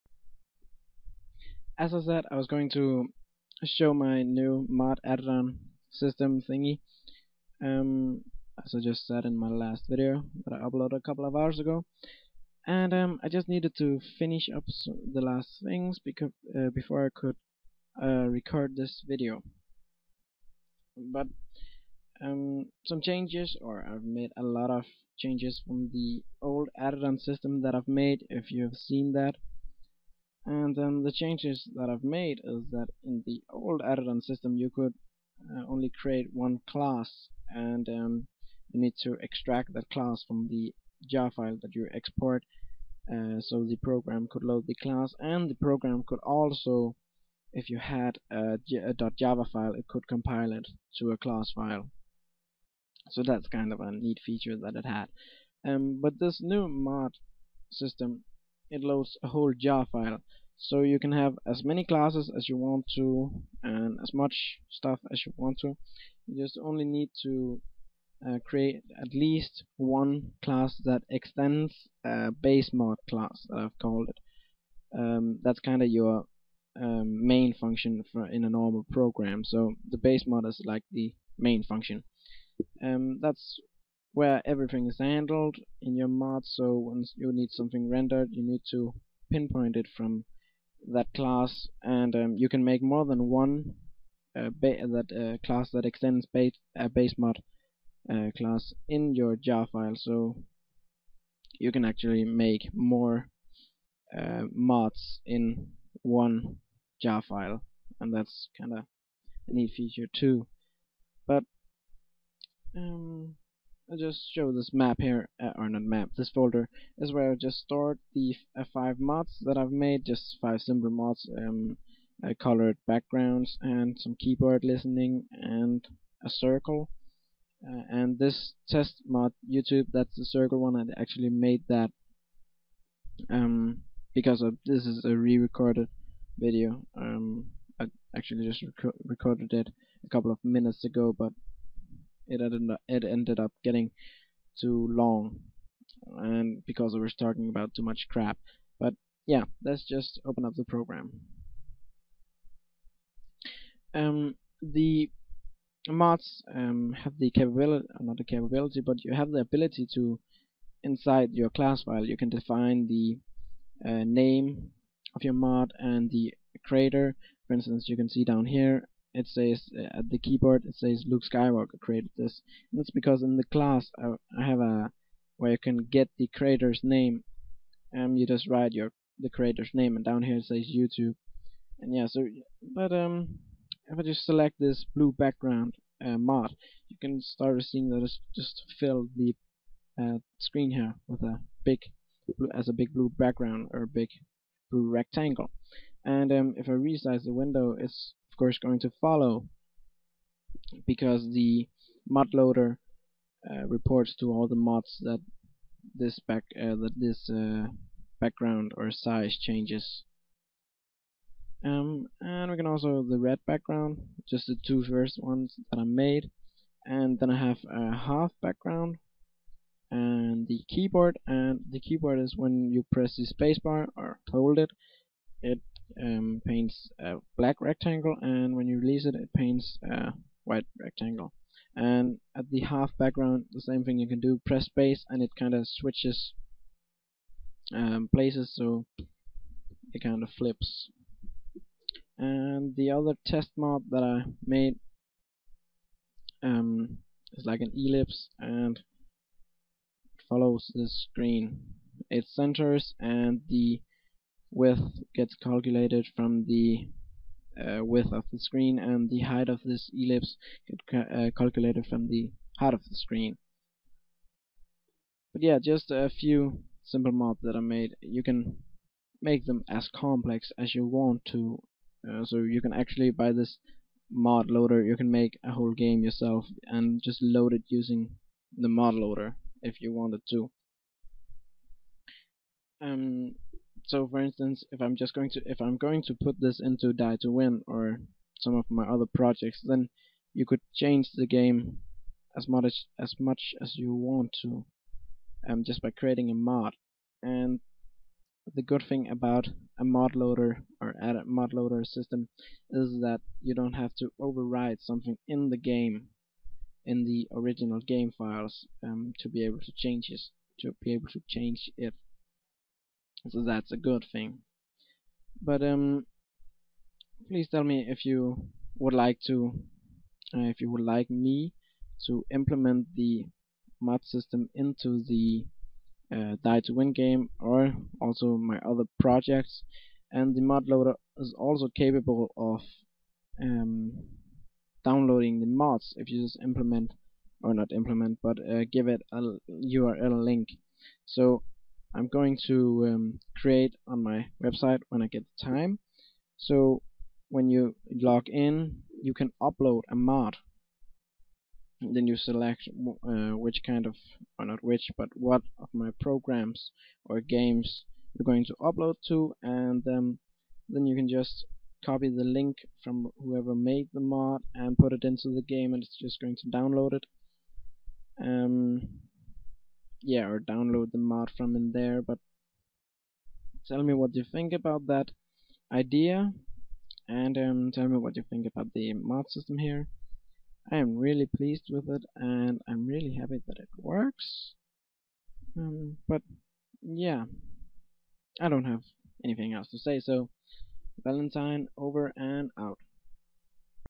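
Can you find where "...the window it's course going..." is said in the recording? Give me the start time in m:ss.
3:17.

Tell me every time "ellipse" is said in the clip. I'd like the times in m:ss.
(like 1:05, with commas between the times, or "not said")
4:07, 4:19.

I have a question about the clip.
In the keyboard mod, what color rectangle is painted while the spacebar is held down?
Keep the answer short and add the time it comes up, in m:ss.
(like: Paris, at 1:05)
black, at 3:47.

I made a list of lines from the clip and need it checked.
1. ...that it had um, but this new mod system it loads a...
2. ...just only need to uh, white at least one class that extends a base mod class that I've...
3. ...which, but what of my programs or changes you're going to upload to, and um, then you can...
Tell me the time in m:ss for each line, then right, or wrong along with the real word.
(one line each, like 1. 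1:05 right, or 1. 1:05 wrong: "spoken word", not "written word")
1. 0:54 right
2. 1:06 wrong: "create", not "white"
3. 5:54 wrong: "games", not "changes".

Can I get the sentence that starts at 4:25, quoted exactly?
But yeah, just a few simple mods that I made.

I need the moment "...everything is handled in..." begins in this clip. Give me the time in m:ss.
1:24.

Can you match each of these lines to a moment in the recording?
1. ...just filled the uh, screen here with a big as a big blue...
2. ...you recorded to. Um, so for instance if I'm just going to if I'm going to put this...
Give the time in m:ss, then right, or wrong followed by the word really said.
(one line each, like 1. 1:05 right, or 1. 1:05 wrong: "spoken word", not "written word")
1. 3:08 right
2. 4:39 wrong: "wanted", not "recorded".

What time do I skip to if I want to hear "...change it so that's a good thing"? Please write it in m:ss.
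5:11.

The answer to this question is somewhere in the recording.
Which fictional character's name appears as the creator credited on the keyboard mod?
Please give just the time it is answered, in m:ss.
2:51.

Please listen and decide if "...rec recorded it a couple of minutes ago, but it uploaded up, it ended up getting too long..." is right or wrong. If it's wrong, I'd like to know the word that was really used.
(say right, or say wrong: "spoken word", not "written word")
wrong: "ended", not "uploaded".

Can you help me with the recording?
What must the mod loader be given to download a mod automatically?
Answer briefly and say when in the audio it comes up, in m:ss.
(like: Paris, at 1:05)
a URL link, at 5:39.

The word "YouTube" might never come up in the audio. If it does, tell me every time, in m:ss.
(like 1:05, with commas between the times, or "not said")
2:09, 3:00.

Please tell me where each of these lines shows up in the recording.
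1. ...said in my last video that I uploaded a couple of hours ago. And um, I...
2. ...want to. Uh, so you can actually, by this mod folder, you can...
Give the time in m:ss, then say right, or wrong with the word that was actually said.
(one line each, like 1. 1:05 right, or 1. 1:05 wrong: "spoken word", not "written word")
1. 0:09 right
2. 4:30 wrong: "loader", not "folder".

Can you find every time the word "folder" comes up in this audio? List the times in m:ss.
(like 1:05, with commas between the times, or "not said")
1:56.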